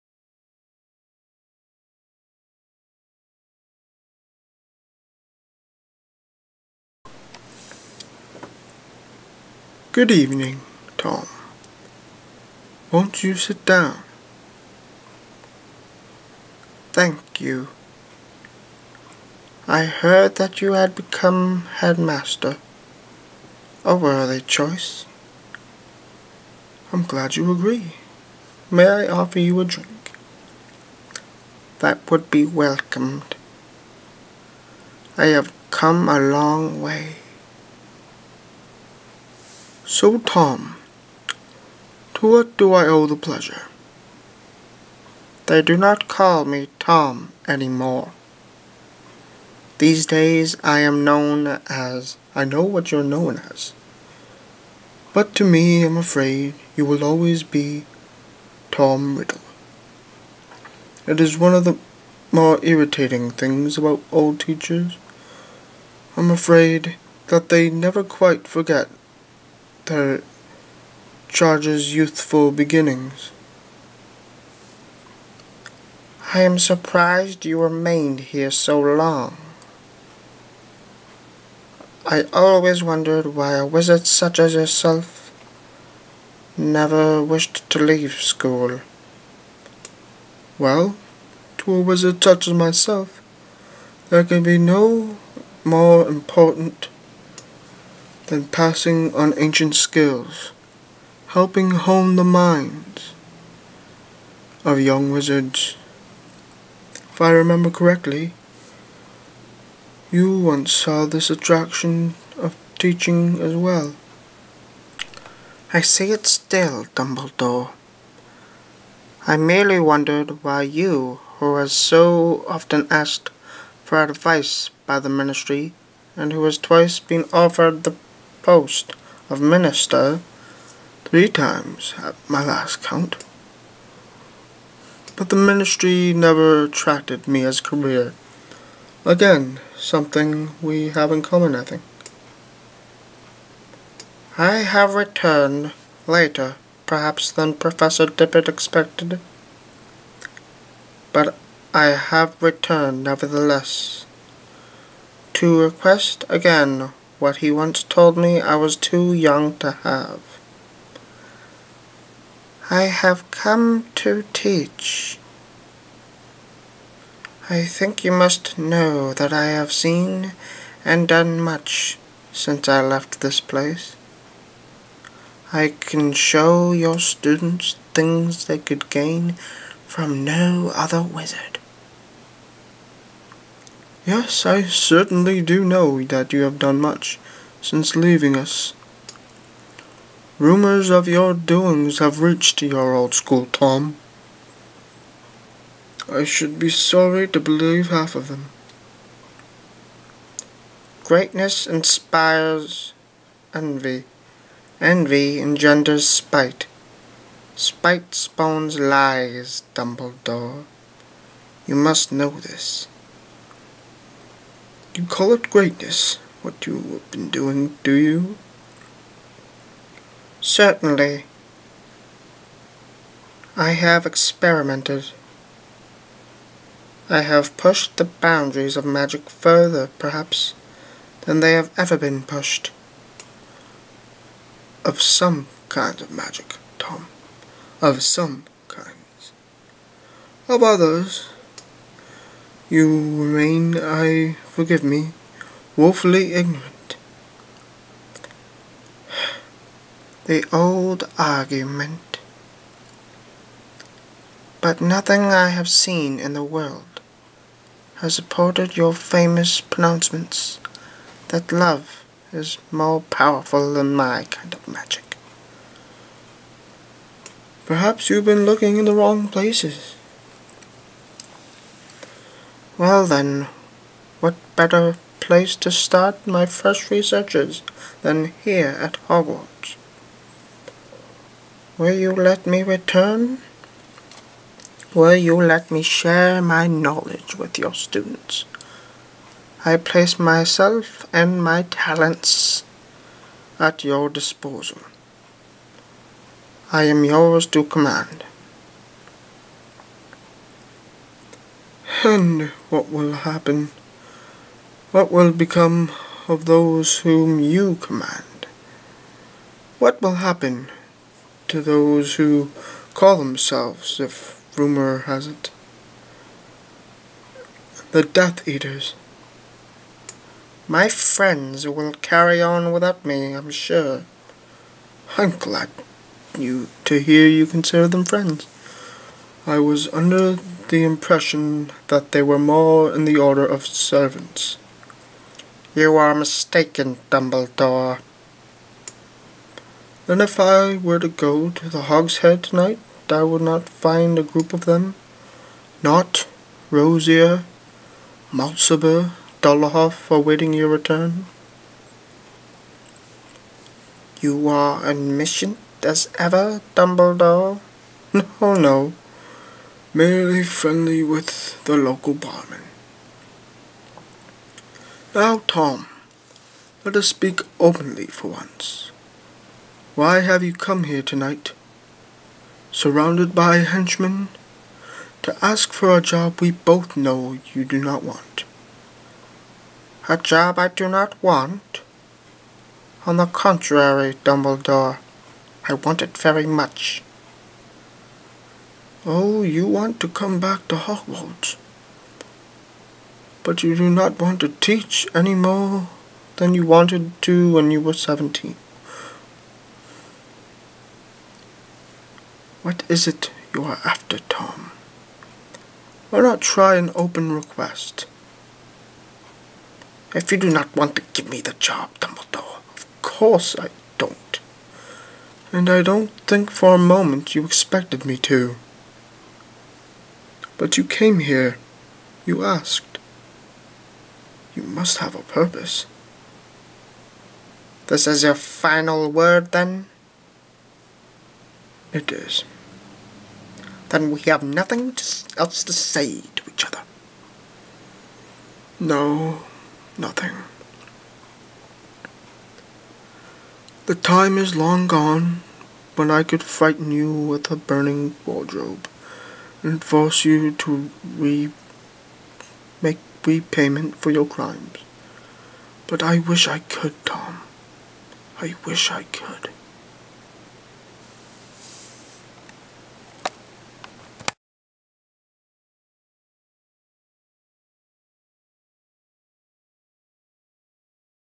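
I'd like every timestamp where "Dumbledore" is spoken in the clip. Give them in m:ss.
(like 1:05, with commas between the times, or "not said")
1:56, 3:29, 5:37, 5:56, 6:24, 6:51.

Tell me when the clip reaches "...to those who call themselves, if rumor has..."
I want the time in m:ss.
5:11.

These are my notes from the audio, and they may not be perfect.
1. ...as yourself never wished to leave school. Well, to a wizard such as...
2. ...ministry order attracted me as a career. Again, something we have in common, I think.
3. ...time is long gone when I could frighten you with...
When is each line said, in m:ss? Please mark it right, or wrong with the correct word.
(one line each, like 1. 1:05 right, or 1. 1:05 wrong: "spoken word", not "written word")
1. 1:24 right
2. 2:15 wrong: "never", not "order"
3. 7:23 right.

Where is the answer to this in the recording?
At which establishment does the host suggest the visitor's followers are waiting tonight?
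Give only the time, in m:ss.
5:41.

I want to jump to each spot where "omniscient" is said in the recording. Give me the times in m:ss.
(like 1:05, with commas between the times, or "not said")
5:54.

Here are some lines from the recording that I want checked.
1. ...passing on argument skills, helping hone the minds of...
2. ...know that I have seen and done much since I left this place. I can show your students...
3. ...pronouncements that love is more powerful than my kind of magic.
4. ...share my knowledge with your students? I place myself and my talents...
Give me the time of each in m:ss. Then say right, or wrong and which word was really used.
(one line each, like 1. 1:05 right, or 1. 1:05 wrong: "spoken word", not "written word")
1. 1:38 wrong: "ancient", not "argument"
2. 2:48 right
3. 4:19 right
4. 4:45 right.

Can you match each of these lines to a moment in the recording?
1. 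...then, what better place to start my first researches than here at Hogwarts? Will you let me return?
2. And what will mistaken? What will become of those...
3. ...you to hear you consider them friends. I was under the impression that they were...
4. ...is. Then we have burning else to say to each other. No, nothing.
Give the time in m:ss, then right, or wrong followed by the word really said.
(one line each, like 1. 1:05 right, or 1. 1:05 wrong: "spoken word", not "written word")
1. 4:33 right
2. 5:02 wrong: "happen", not "mistaken"
3. 5:26 right
4. 7:12 wrong: "nothing", not "burning".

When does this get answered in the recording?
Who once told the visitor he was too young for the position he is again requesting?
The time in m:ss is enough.
2:27.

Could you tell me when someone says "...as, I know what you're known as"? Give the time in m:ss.
0:51.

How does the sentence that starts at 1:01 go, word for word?
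It is one of the more irritating things about old teachers.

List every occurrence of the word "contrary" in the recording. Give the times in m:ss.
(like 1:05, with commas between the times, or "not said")
6:23.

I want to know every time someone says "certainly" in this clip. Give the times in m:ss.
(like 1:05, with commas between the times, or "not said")
3:04, 3:40.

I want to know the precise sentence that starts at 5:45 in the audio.
Not Rosier, Mulciber, Dolohov awaiting your return.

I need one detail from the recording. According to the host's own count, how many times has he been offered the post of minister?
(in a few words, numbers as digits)
3.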